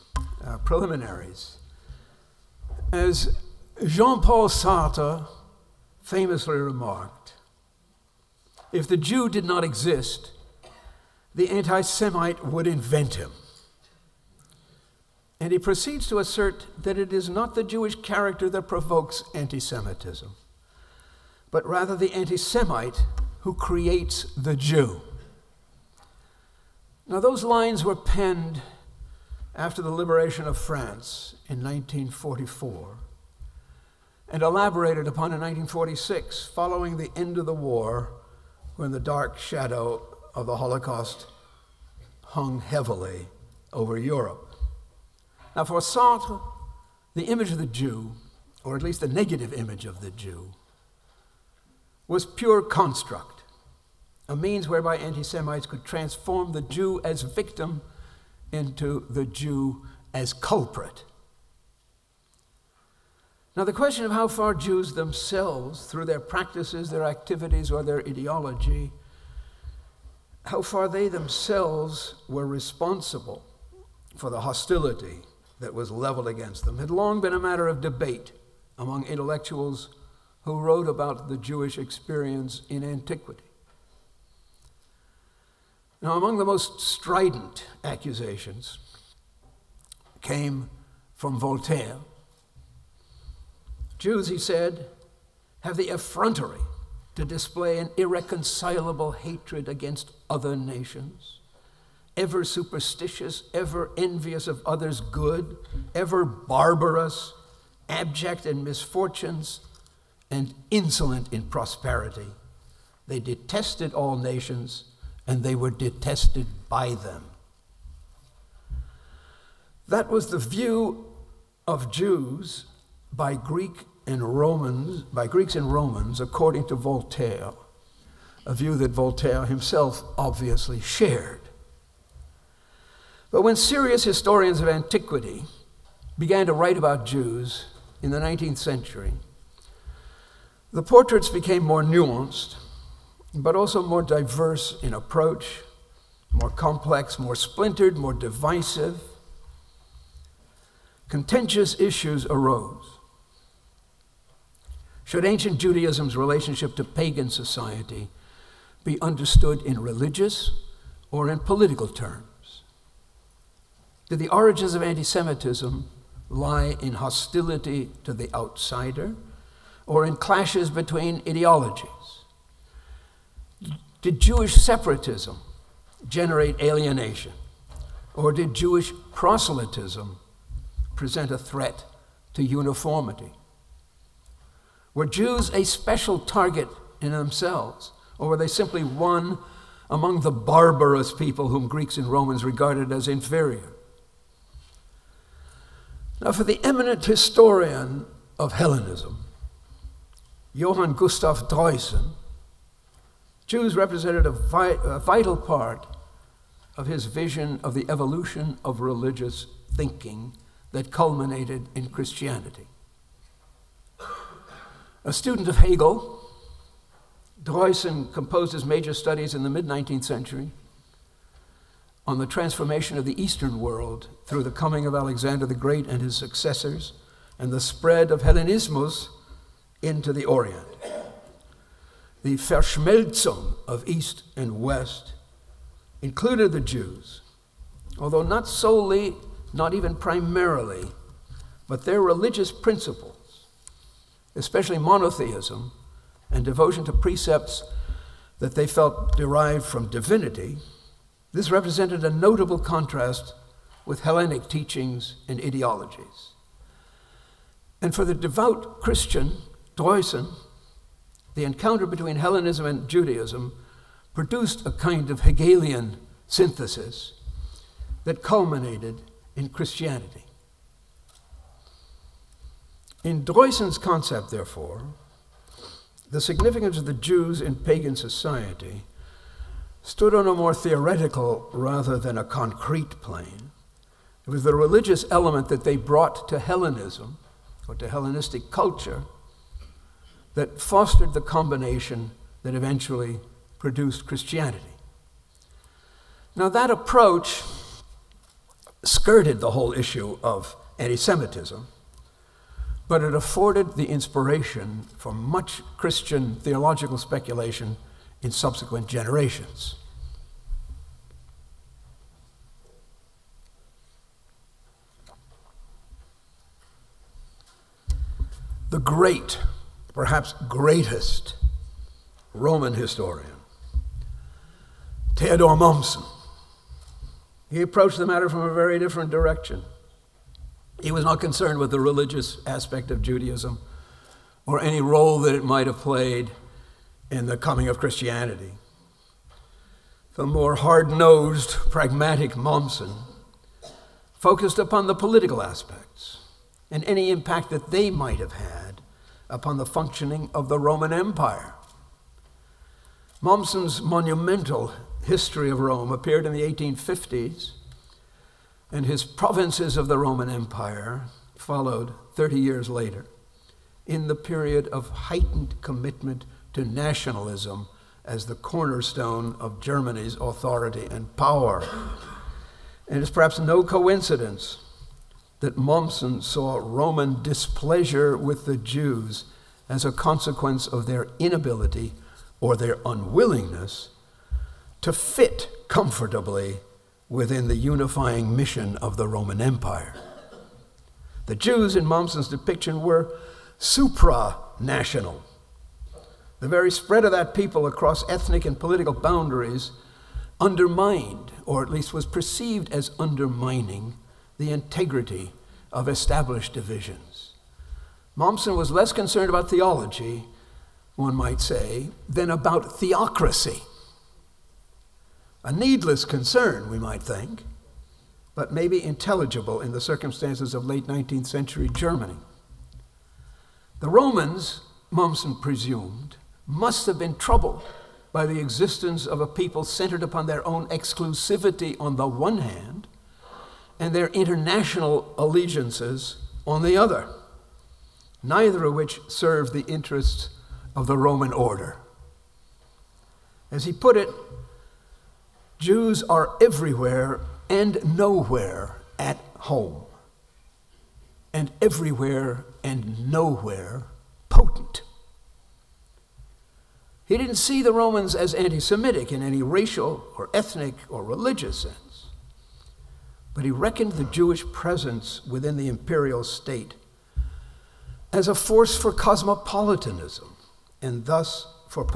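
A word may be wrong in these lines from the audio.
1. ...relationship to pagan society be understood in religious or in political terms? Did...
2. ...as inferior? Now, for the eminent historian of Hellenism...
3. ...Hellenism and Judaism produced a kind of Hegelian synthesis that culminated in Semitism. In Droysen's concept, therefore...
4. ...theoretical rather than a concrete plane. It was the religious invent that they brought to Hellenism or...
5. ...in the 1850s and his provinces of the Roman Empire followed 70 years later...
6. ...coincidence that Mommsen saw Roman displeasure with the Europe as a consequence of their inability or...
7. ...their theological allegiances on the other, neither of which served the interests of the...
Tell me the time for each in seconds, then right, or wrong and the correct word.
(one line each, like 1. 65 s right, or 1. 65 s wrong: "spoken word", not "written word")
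1. 156 s right
2. 192 s right
3. 262 s wrong: "Christianity", not "Semitism"
4. 280 s wrong: "element", not "invent"
5. 356 s wrong: "30", not "70"
6. 373 s wrong: "Jews", not "Europe"
7. 433 s wrong: "international", not "theological".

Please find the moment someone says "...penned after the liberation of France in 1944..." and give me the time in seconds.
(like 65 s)
27 s.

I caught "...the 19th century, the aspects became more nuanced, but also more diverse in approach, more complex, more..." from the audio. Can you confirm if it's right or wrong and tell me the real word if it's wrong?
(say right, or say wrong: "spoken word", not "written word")
wrong: "portraits", not "aspects".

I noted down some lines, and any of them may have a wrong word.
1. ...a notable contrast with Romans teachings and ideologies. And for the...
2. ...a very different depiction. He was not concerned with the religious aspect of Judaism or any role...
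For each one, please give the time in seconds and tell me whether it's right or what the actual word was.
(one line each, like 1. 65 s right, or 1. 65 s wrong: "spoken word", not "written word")
1. 252 s wrong: "Hellenic", not "Romans"
2. 328 s wrong: "direction", not "depiction".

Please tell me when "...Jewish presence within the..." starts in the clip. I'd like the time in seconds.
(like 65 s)
464 s.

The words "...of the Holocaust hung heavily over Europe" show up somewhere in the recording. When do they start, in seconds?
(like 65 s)
40 s.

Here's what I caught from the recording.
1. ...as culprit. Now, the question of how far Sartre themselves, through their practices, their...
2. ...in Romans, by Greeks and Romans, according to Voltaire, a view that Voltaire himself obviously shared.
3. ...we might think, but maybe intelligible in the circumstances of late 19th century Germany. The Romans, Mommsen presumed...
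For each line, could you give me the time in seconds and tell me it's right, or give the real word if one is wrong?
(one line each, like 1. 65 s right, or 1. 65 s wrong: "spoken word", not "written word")
1. 60 s wrong: "Jews", not "Sartre"
2. 124 s right
3. 416 s right.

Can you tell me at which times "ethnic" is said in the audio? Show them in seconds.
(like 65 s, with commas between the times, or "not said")
398 s, 460 s.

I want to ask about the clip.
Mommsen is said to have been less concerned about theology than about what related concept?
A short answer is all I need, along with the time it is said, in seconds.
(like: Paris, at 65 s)
theocracy, at 412 s.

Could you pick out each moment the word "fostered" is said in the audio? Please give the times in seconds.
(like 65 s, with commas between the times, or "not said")
290 s.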